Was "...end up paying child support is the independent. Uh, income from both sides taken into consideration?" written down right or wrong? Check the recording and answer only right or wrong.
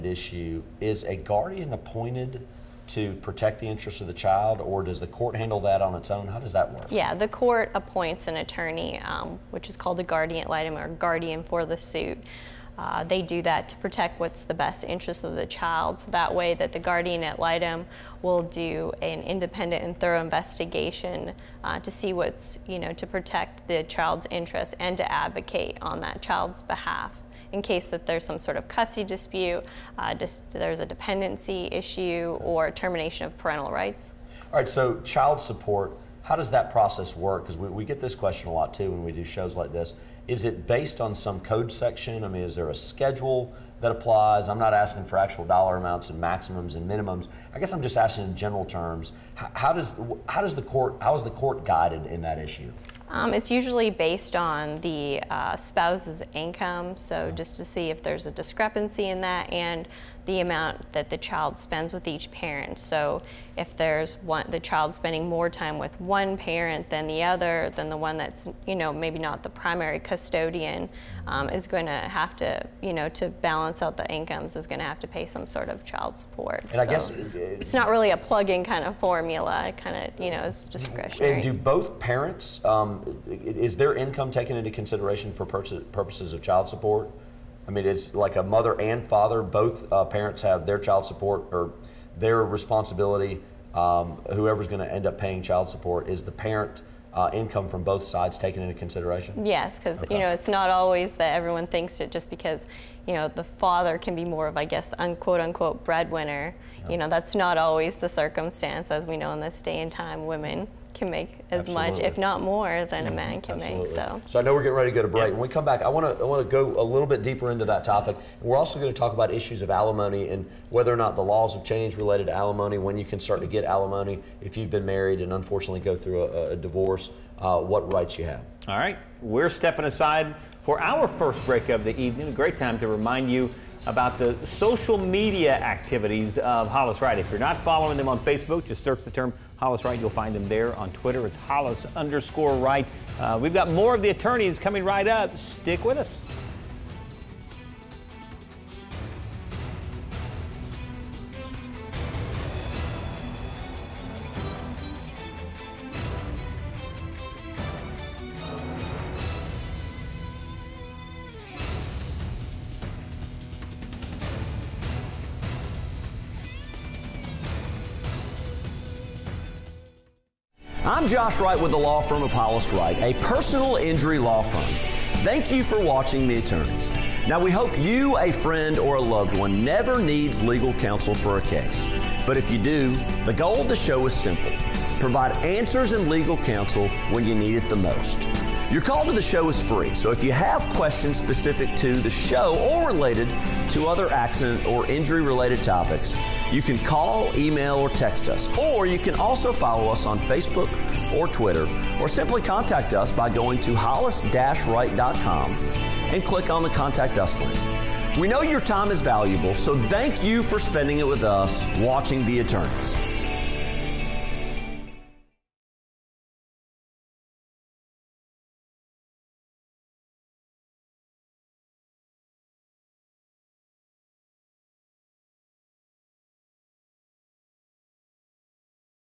wrong.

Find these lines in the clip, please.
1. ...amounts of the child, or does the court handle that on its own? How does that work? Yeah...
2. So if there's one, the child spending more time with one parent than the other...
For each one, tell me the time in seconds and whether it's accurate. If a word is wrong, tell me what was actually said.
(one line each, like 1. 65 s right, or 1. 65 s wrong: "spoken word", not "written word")
1. 3 s wrong: "interests", not "amounts"
2. 62 s right.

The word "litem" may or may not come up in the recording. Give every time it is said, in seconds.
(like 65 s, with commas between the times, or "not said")
10 s, 17 s.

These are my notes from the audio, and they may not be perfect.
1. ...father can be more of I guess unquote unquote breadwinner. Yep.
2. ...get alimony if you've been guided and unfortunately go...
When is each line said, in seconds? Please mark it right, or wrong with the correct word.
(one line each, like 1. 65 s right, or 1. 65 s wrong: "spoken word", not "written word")
1. 103 s right
2. 123 s wrong: "married", not "guided".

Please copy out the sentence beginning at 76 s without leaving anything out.
And so I guess it, it, it's not really a plug-in kind of formula.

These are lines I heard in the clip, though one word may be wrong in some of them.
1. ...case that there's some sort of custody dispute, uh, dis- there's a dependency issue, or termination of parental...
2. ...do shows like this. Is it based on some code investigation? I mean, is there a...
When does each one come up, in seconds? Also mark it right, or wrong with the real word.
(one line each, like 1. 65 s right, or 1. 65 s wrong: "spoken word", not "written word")
1. 27 s right
2. 39 s wrong: "section", not "investigation".